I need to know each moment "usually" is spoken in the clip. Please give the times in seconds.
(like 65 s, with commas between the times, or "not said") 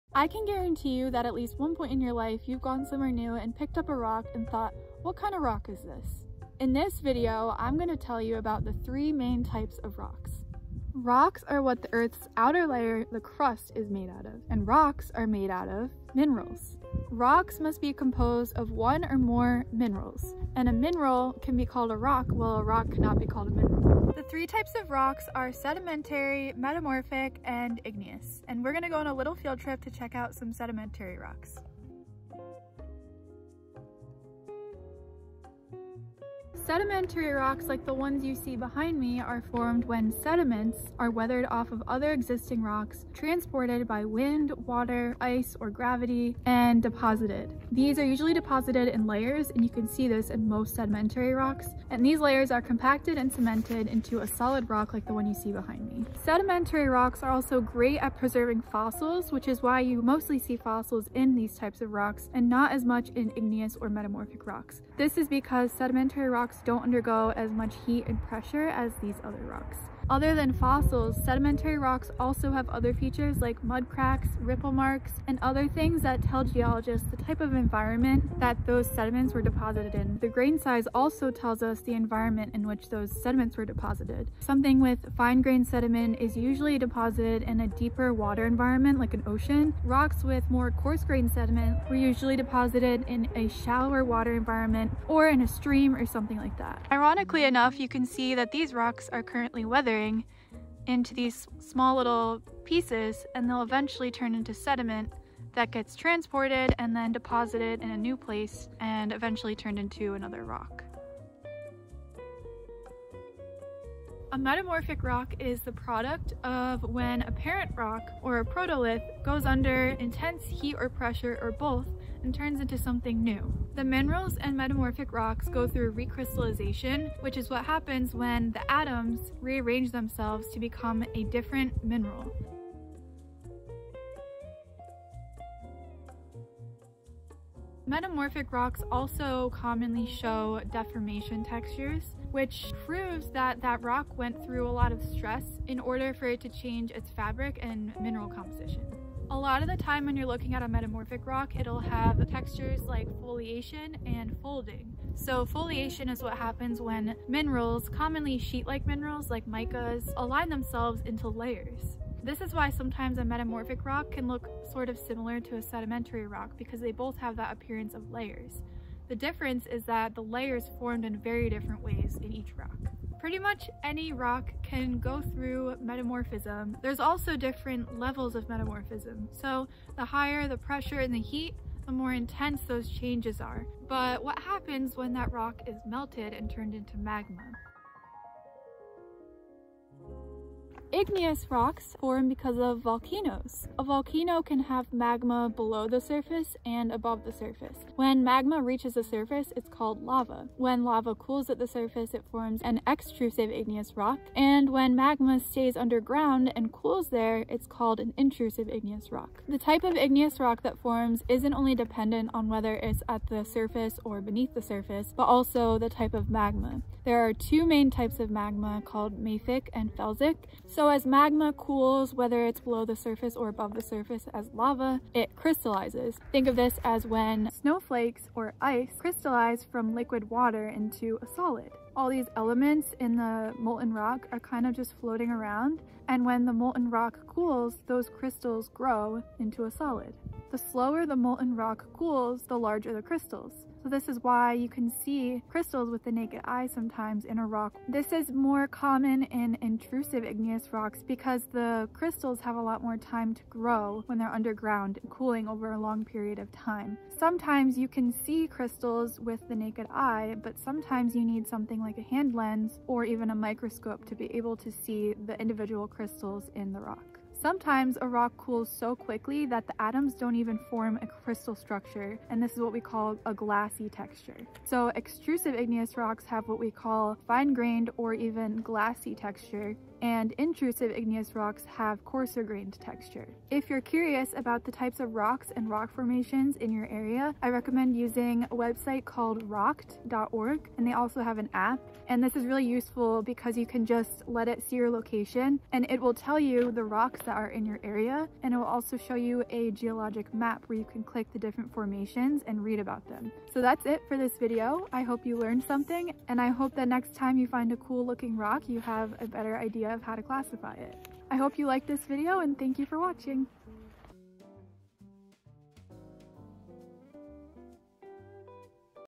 48 s, 86 s, 91 s.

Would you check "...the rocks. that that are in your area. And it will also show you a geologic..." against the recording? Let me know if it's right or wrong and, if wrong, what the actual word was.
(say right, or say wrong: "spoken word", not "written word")
right.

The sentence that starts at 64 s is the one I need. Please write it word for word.
This is because sedimentary rocks rocks don't undergo as much heat and pressure as these other rocks.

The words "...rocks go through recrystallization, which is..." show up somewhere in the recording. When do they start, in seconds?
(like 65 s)
125 s.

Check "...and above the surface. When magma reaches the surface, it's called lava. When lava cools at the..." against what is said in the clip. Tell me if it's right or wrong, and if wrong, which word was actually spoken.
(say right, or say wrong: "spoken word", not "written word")
right.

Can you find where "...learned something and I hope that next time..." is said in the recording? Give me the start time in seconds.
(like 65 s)
305 s.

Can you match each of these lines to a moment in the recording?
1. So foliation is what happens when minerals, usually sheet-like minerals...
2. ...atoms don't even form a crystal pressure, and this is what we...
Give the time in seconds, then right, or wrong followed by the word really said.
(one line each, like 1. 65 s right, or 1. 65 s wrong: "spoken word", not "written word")
1. 155 s wrong: "commonly", not "usually"
2. 269 s wrong: "structure", not "pressure".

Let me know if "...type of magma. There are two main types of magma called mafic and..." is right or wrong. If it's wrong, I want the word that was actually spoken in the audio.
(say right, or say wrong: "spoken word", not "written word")
right.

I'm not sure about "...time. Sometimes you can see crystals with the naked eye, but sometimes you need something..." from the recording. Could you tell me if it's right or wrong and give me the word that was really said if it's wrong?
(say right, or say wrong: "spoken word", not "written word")
right.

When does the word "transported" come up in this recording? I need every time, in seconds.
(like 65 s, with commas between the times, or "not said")
43 s, 105 s.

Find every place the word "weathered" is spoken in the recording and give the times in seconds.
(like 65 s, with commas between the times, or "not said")
41 s, 99 s.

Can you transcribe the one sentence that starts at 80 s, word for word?
The grain size also tells us the environment in which those sediments were deposited.